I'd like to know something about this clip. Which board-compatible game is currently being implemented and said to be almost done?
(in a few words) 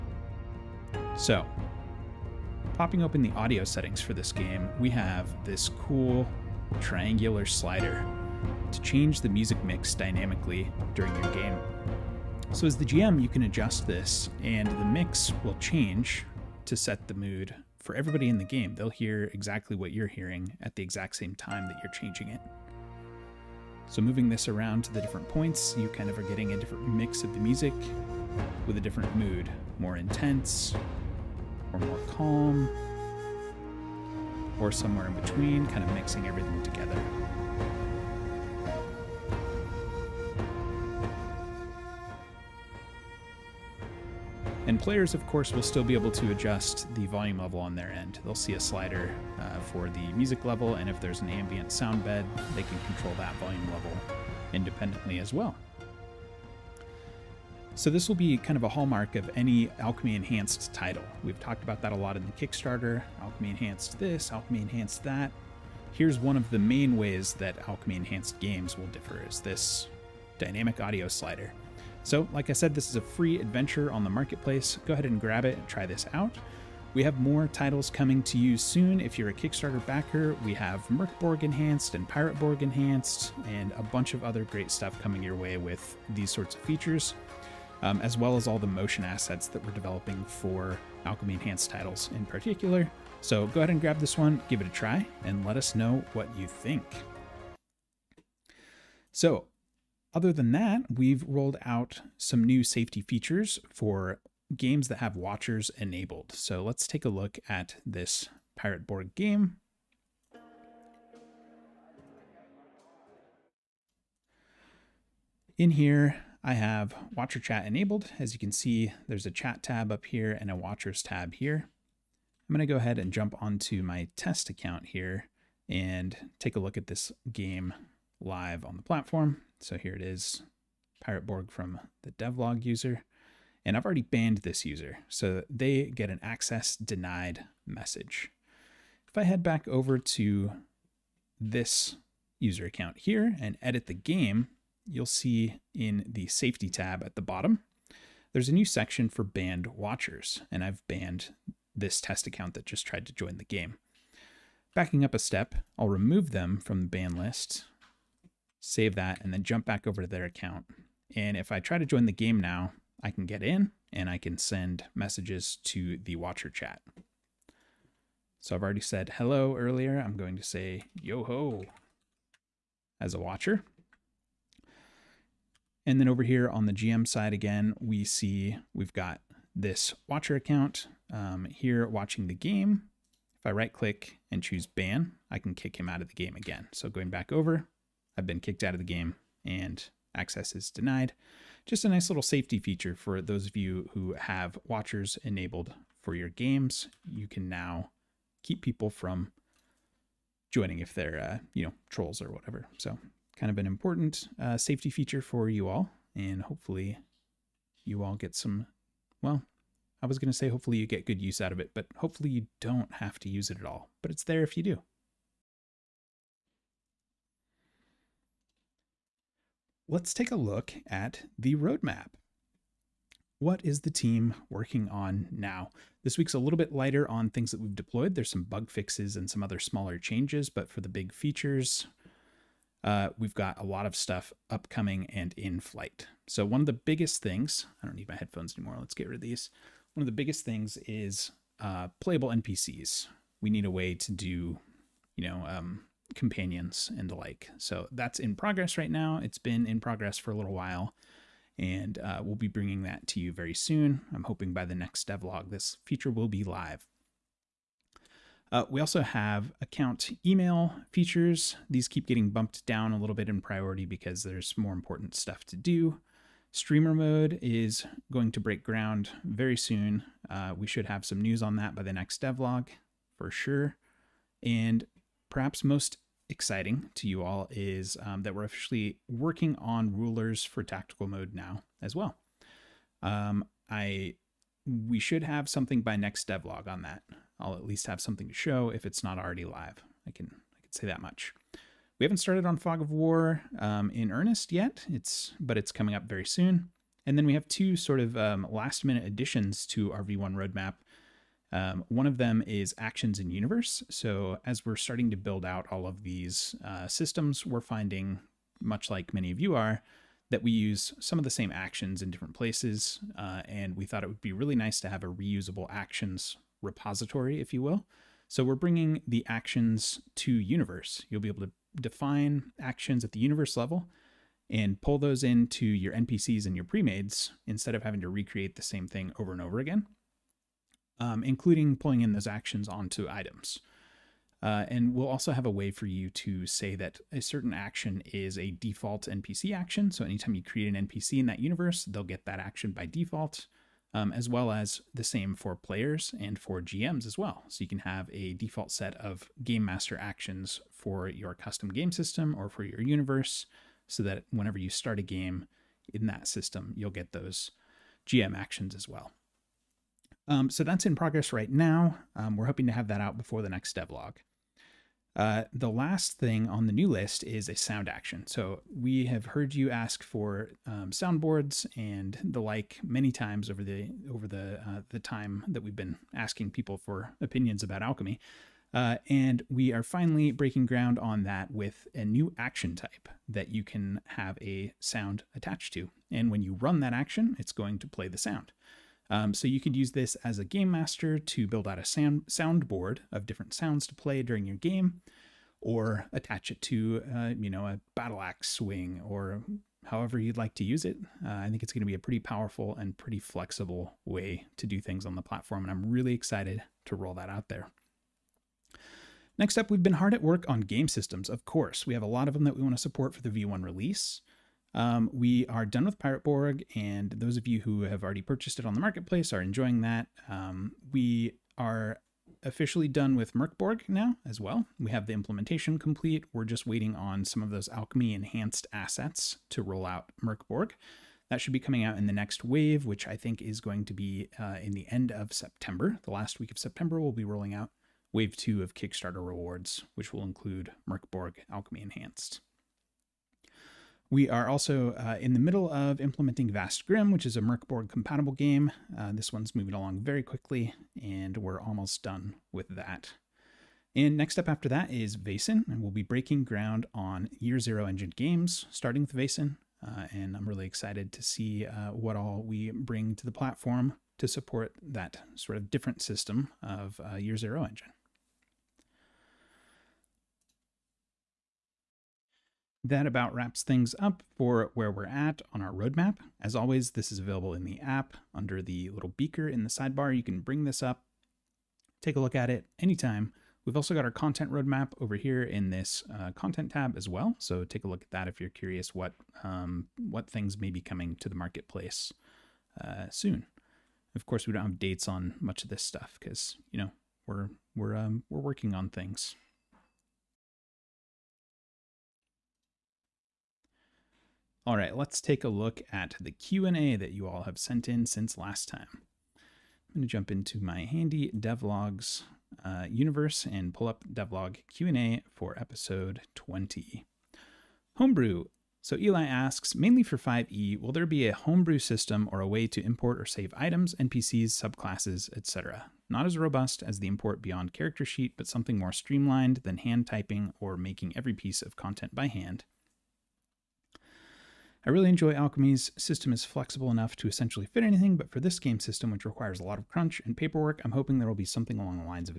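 Vast Grimm.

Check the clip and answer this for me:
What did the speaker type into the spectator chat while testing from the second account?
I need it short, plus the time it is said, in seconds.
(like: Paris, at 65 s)
Yo ho, at 171 s.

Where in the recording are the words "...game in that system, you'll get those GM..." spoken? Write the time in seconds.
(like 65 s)
355 s.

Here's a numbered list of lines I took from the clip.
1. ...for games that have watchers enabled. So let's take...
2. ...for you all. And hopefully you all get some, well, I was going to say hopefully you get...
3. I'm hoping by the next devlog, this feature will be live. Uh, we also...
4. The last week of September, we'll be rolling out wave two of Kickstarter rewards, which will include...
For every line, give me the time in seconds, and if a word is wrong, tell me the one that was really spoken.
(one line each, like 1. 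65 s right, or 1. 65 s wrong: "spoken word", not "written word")
1. 103 s right
2. 205 s right
3. 254 s right
4. 436 s right.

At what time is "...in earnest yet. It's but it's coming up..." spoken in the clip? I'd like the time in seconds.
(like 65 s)
293 s.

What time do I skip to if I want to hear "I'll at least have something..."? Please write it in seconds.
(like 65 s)
287 s.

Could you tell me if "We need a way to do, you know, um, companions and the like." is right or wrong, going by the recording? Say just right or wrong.
right.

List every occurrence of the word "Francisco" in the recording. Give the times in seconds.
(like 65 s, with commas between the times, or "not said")
not said.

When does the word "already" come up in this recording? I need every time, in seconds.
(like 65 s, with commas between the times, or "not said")
133 s, 168 s, 289 s, 418 s.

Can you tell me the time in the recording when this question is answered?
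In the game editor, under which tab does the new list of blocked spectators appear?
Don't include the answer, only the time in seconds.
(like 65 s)
146 s.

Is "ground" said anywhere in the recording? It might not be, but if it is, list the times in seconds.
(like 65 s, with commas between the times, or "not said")
268 s, 380 s, 456 s.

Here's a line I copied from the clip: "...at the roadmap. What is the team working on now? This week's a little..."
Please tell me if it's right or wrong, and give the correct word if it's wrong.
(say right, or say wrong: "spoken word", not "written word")
right.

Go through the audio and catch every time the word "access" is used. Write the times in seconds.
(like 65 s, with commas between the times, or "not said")
136 s, 190 s.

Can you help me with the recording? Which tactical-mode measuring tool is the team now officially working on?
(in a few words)
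Rulers.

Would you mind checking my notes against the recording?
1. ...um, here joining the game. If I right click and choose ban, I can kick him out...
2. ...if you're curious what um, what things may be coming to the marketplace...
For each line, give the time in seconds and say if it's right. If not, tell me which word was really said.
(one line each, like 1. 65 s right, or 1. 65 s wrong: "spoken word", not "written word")
1. 181 s wrong: "watching", not "joining"
2. 488 s right.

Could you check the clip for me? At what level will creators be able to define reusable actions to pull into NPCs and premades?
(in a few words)
Universe level.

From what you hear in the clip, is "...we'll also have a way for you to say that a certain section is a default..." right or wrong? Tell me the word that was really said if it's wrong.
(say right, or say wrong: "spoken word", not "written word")
wrong: "action", not "section".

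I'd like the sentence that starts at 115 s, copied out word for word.
In here, I have watcher chat enabled.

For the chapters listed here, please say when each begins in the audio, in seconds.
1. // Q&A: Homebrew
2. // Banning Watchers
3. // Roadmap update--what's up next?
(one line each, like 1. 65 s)
1. 517 s
2. 97 s
3. 217 s.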